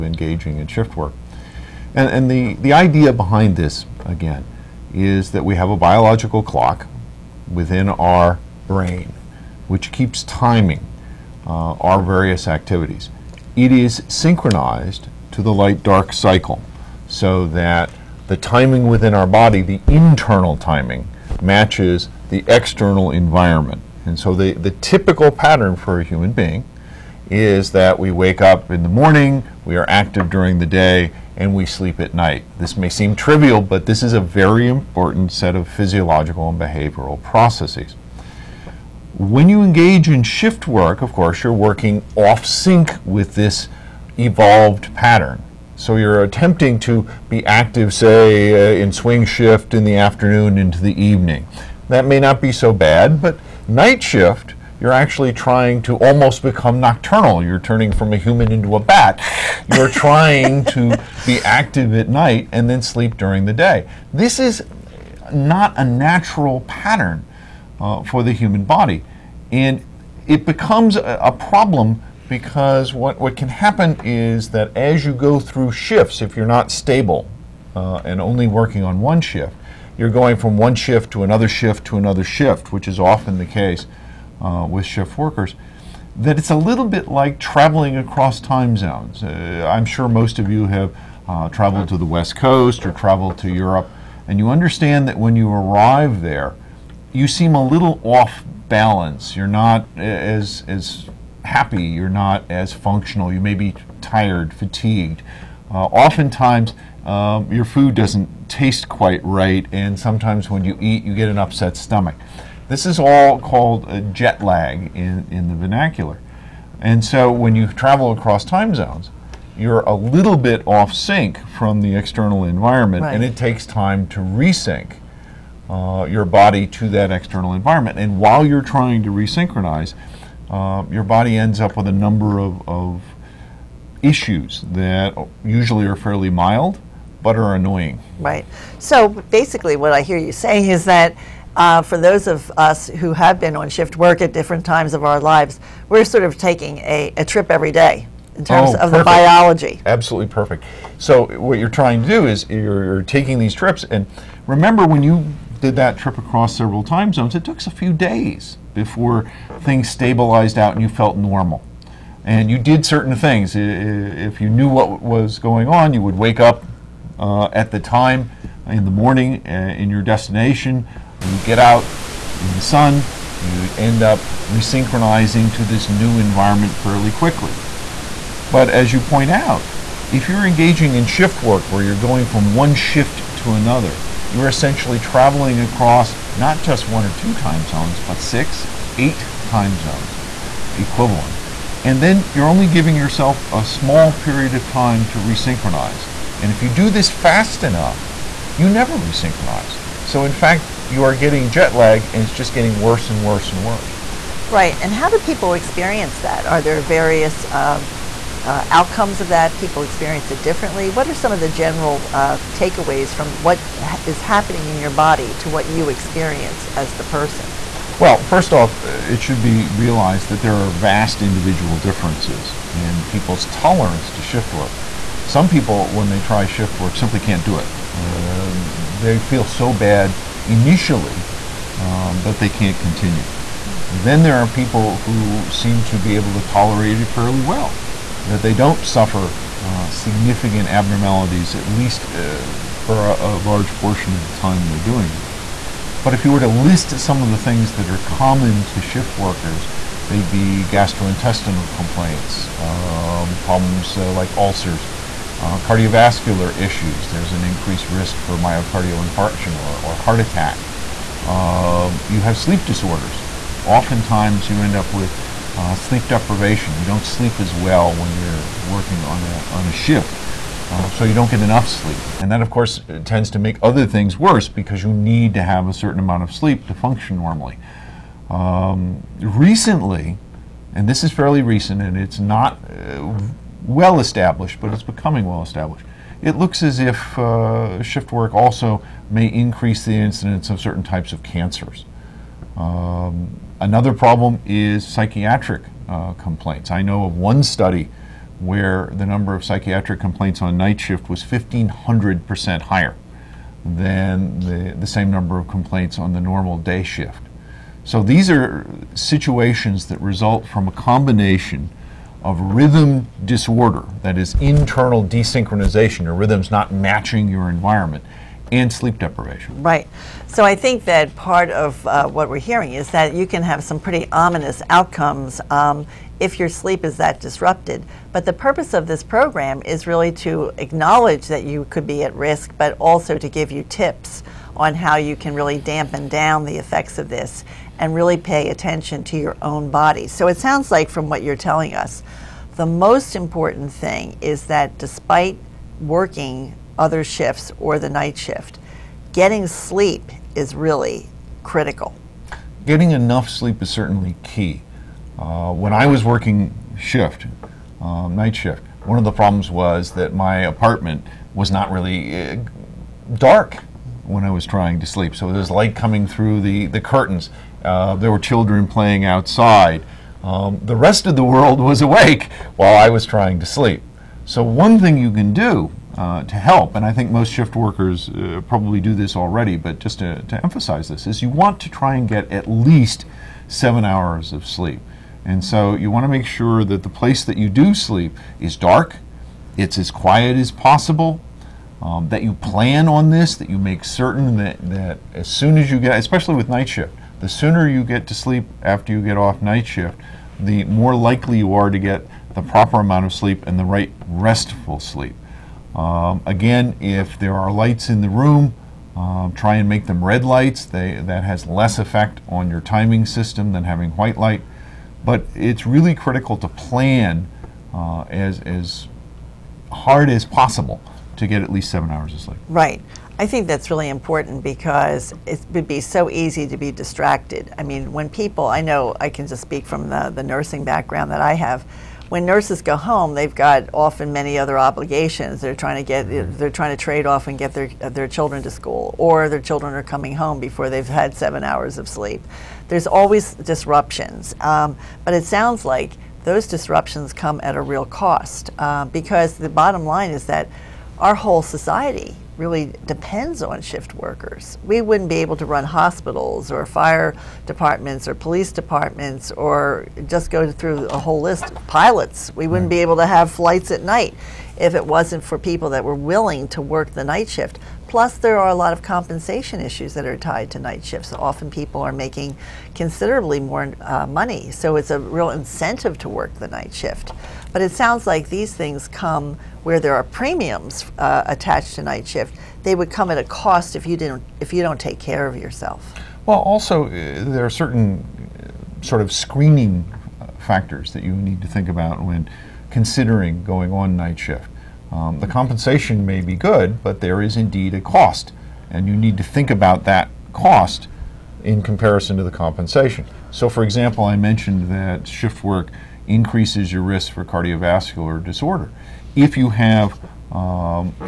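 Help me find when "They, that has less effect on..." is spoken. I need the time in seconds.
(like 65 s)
410 s.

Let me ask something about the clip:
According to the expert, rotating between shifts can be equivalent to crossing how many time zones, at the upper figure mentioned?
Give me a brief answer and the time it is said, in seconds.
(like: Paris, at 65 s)
8, at 188 s.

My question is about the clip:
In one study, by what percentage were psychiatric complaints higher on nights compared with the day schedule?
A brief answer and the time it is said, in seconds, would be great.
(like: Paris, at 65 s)
1,500%, at 301 s.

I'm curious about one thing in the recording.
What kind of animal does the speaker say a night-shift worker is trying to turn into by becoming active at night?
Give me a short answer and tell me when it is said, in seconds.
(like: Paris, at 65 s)
bat, at 58 s.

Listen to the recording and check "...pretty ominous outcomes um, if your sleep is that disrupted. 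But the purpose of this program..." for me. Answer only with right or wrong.
right.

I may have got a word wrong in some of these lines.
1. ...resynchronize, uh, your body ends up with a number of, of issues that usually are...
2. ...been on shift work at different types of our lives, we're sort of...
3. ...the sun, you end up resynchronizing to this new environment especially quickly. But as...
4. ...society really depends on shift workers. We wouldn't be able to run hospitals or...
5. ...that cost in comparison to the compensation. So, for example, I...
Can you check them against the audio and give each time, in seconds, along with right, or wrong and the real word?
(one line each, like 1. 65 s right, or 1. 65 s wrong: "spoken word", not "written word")
1. 129 s right
2. 143 s wrong: "times", not "types"
3. 172 s wrong: "fairly", not "especially"
4. 451 s right
5. 499 s right.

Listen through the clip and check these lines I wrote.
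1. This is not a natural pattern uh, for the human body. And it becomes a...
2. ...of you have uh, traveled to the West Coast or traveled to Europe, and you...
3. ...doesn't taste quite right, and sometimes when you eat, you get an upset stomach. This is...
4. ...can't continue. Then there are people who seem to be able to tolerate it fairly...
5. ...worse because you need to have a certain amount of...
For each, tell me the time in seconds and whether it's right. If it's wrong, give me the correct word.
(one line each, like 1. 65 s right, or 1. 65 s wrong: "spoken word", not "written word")
1. 64 s right
2. 90 s right
3. 107 s right
4. 232 s right
5. 274 s right.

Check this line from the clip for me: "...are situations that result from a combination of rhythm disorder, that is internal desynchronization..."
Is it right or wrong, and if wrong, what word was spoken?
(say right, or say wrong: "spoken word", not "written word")
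right.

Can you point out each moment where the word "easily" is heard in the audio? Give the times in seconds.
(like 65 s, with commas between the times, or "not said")
not said.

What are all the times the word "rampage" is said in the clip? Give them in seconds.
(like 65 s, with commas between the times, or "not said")
not said.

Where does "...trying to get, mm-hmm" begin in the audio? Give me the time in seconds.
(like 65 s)
435 s.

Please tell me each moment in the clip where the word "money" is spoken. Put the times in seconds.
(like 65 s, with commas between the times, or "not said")
474 s.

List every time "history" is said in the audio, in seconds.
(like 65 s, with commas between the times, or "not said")
not said.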